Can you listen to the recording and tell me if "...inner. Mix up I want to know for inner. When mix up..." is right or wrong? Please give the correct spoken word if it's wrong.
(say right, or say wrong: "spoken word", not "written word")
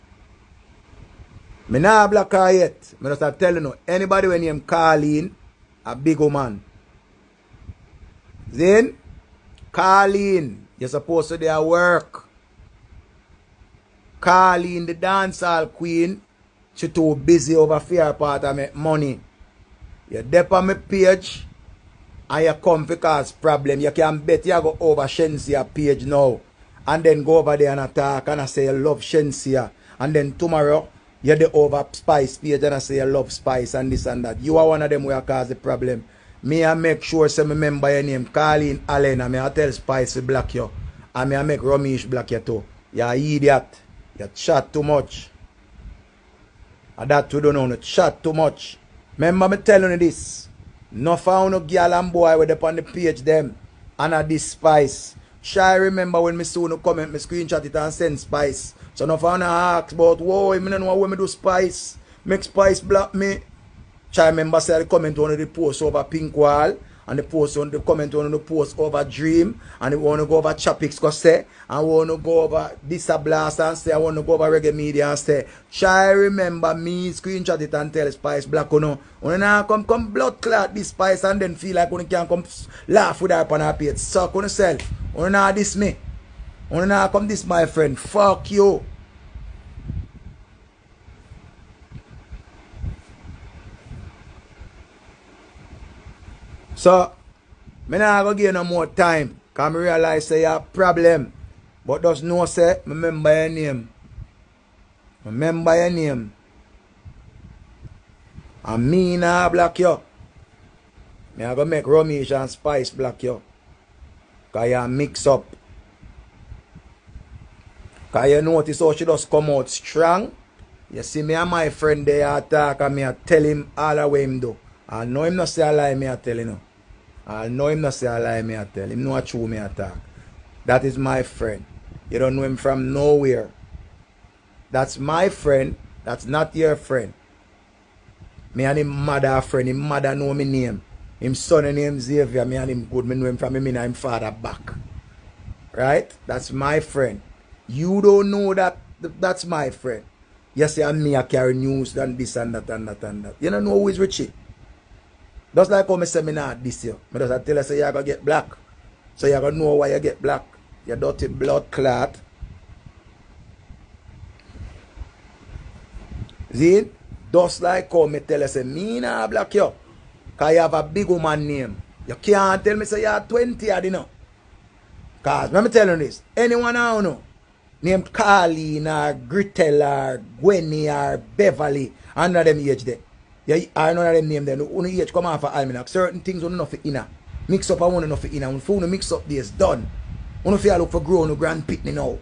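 right.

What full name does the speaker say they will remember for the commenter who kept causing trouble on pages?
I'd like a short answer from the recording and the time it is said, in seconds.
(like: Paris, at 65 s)
Colleen Allen, at 38 s.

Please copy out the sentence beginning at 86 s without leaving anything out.
When I come this, my friend, fuck you.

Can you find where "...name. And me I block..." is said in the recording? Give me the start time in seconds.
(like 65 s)
105 s.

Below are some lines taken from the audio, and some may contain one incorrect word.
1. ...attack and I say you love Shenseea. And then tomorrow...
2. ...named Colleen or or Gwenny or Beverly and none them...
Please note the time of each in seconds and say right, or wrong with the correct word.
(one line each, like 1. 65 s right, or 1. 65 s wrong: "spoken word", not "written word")
1. 27 s right
2. 177 s right.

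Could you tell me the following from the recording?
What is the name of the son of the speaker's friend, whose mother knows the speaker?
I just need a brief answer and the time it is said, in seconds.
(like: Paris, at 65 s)
Xavier, at 141 s.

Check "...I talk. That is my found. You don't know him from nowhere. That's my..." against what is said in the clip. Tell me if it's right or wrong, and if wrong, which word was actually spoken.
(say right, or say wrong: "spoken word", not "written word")
wrong: "friend", not "found".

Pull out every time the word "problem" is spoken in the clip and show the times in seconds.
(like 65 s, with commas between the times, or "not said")
23 s, 35 s, 100 s.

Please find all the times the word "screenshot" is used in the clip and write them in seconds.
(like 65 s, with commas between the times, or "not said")
57 s, 77 s.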